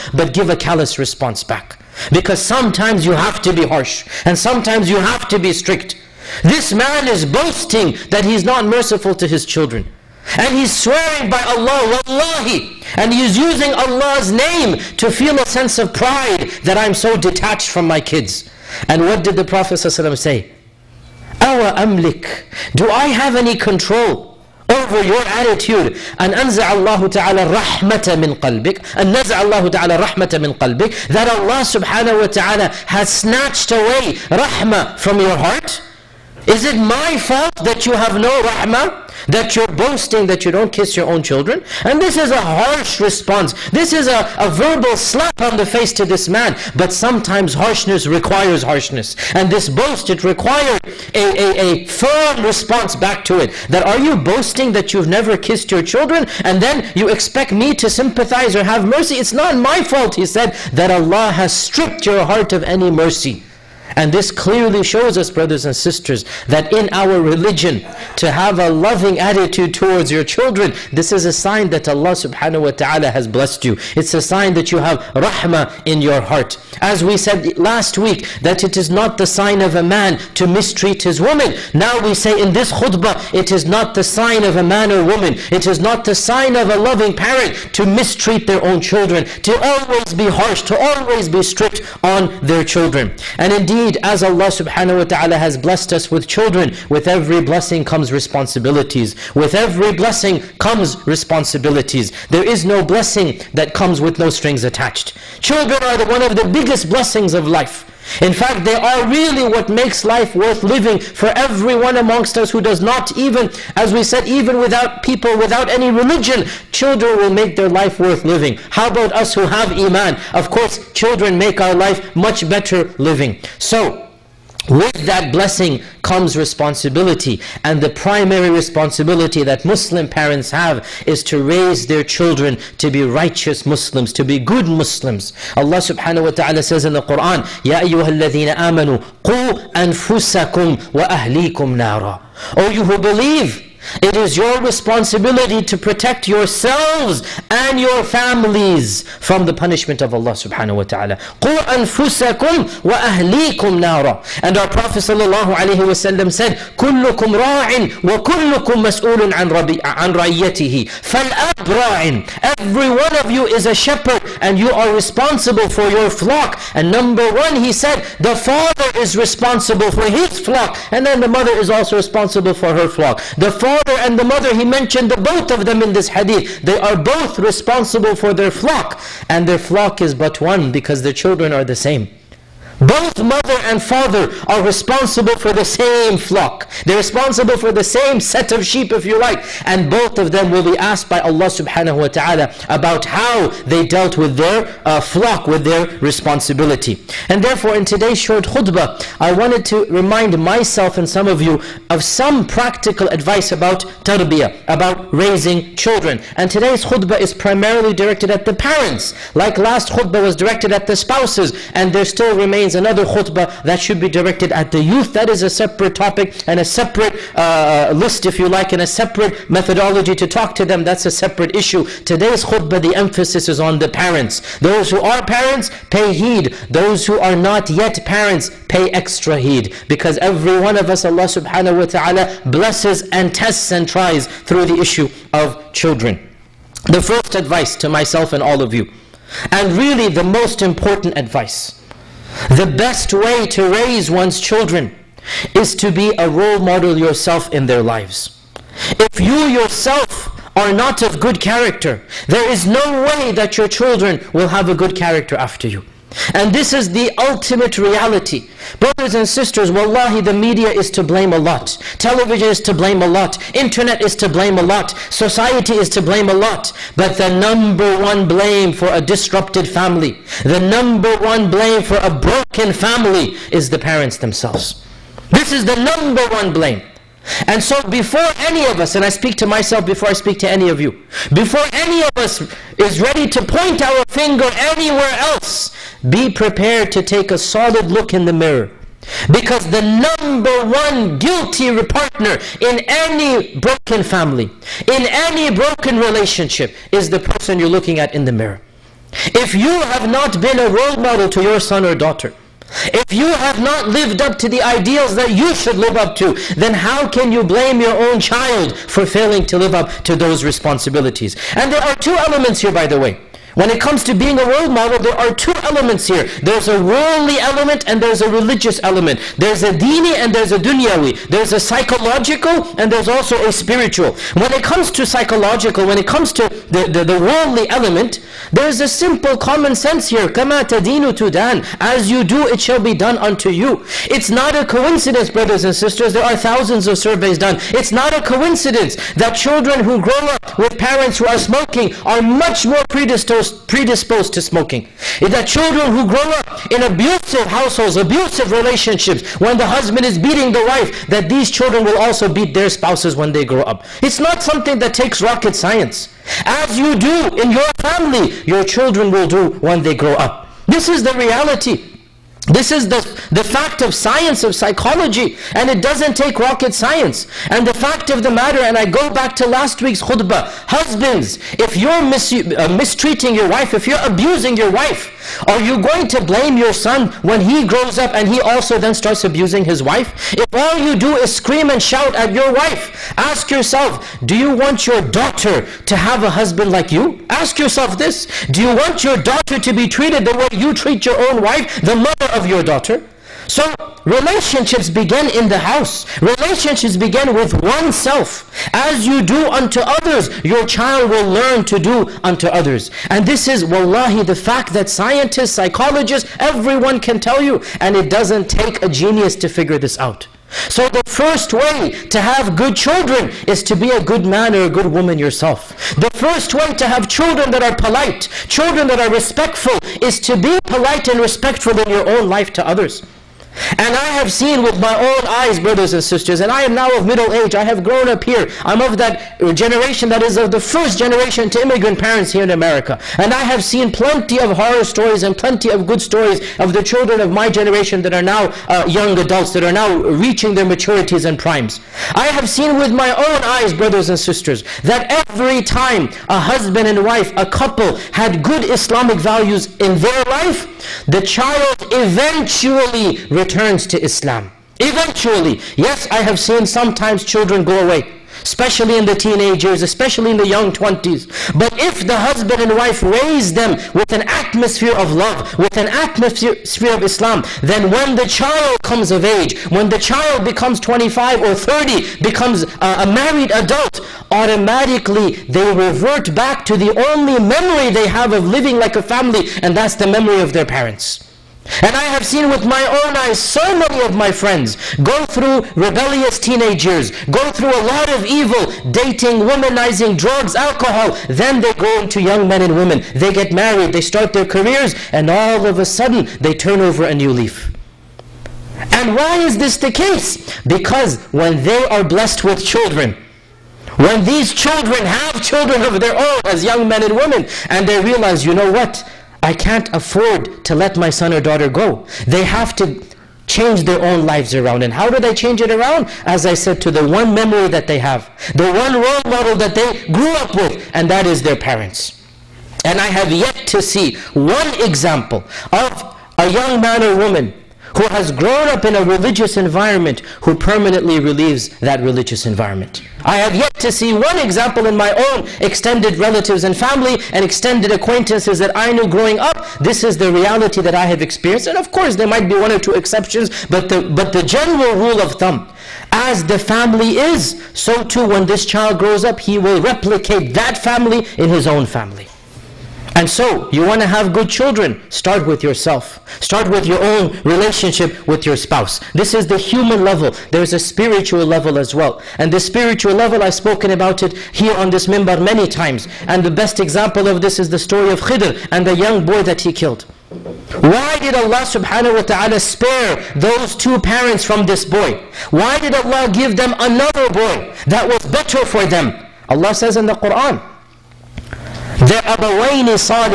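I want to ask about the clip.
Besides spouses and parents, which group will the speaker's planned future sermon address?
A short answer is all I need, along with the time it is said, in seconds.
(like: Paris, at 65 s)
The youth, at 214 s.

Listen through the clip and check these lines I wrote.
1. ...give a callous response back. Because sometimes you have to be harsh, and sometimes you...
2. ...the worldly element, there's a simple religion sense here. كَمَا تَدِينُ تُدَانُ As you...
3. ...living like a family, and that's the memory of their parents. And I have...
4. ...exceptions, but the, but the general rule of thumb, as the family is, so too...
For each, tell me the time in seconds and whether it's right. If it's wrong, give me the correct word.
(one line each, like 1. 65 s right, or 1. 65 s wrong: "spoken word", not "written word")
1. 0 s right
2. 327 s wrong: "common", not "religion"
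3. 478 s right
4. 542 s right.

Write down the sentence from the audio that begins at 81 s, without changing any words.
Now we say in this khutbah, it is not the sign of a man or woman.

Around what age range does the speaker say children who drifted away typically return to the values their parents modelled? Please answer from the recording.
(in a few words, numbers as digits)
25 or 30.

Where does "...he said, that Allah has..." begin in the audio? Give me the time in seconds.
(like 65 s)
60 s.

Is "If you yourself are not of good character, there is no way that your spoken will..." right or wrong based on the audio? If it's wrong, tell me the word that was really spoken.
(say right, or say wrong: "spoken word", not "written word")
wrong: "children", not "spoken".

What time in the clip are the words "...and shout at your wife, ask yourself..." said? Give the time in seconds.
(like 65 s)
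381 s.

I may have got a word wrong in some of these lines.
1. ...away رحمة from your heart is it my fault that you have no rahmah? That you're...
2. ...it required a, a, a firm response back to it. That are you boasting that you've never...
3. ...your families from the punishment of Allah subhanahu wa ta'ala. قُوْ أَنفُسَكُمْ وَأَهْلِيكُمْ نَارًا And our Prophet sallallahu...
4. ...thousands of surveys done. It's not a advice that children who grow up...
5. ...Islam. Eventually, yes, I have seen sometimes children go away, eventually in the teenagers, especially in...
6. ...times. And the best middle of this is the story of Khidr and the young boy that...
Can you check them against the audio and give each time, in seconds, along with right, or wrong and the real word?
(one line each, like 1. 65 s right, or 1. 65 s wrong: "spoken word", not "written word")
1. 33 s right
2. 50 s right
3. 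147 s right
4. 336 s wrong: "coincidence", not "advice"
5. 454 s wrong: "especially", not "eventually"
6. 565 s wrong: "example", not "middle".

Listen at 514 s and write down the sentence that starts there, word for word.
And how do they change it around?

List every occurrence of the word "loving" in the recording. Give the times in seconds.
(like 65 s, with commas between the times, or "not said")
68 s, 86 s.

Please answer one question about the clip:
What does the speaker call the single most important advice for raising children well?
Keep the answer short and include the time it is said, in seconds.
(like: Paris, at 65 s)
Be a role model, at 245 s.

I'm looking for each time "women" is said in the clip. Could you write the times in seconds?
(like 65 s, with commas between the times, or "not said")
492 s, 507 s.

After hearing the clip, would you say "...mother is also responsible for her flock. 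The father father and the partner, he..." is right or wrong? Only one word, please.
wrong.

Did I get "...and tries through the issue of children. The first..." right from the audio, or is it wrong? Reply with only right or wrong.
right.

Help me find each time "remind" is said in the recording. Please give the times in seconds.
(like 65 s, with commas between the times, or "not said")
199 s.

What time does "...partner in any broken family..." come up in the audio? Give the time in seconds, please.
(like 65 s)
291 s.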